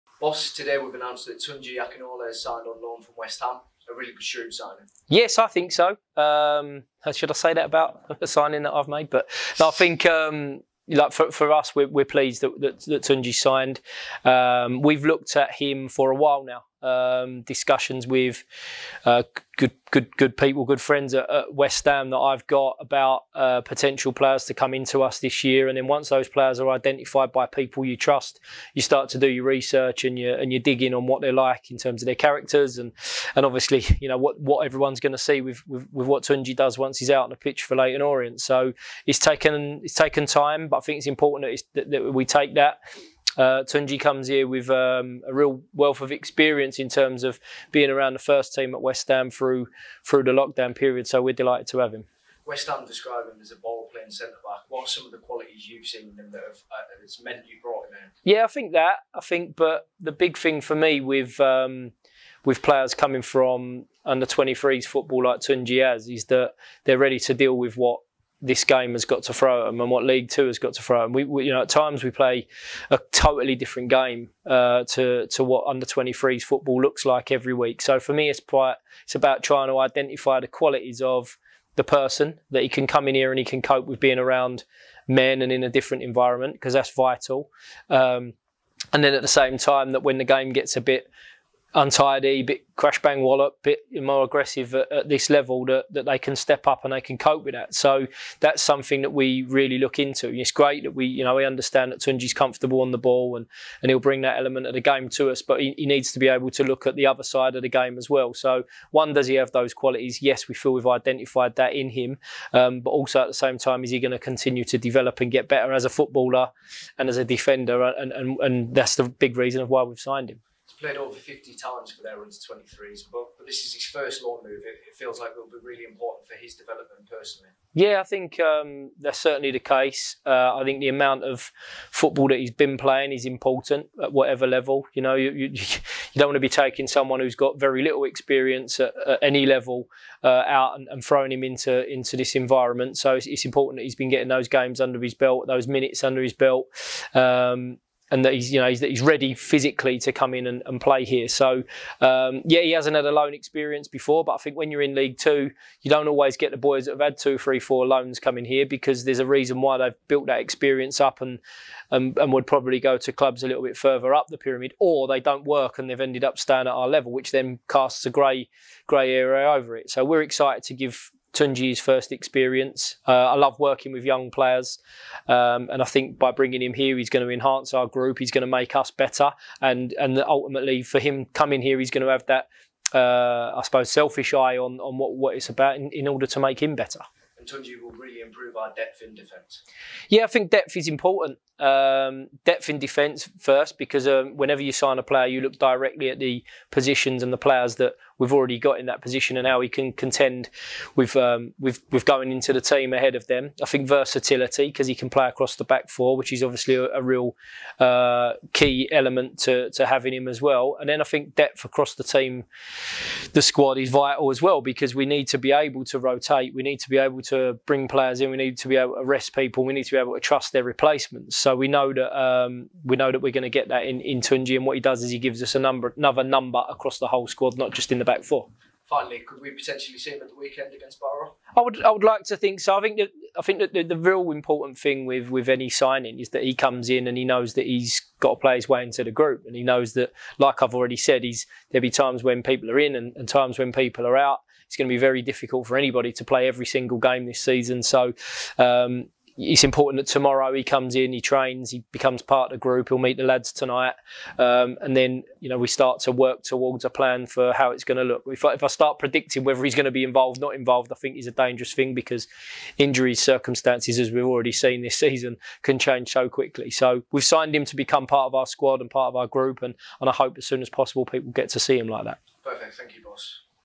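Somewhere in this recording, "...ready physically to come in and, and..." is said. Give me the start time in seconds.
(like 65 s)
149 s.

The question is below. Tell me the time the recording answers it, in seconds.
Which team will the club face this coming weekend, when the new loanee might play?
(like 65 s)
230 s.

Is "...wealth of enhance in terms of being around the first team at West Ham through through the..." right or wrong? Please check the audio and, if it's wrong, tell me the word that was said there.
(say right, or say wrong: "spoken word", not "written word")
wrong: "experience", not "enhance".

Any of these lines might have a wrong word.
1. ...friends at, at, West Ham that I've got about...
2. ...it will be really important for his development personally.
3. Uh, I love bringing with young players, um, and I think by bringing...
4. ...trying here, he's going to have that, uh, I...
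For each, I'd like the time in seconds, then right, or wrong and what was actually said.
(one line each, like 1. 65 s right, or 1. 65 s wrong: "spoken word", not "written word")
1. 20 s right
2. 125 s right
3. 173 s wrong: "working", not "bringing"
4. 181 s wrong: "coming", not "trying".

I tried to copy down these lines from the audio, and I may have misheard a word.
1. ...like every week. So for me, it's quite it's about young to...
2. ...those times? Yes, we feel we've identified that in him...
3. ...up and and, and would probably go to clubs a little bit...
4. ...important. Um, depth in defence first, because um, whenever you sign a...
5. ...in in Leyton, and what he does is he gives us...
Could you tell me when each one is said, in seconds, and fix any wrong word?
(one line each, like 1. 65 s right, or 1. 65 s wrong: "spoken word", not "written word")
1. 77 s wrong: "trying", not "young"
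2. 109 s wrong: "qualities", not "times"
3. 161 s right
4. 190 s right
5. 223 s wrong: "Tunji", not "Leyton".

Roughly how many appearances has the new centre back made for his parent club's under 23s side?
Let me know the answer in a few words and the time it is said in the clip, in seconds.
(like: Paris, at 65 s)
50, at 121 s.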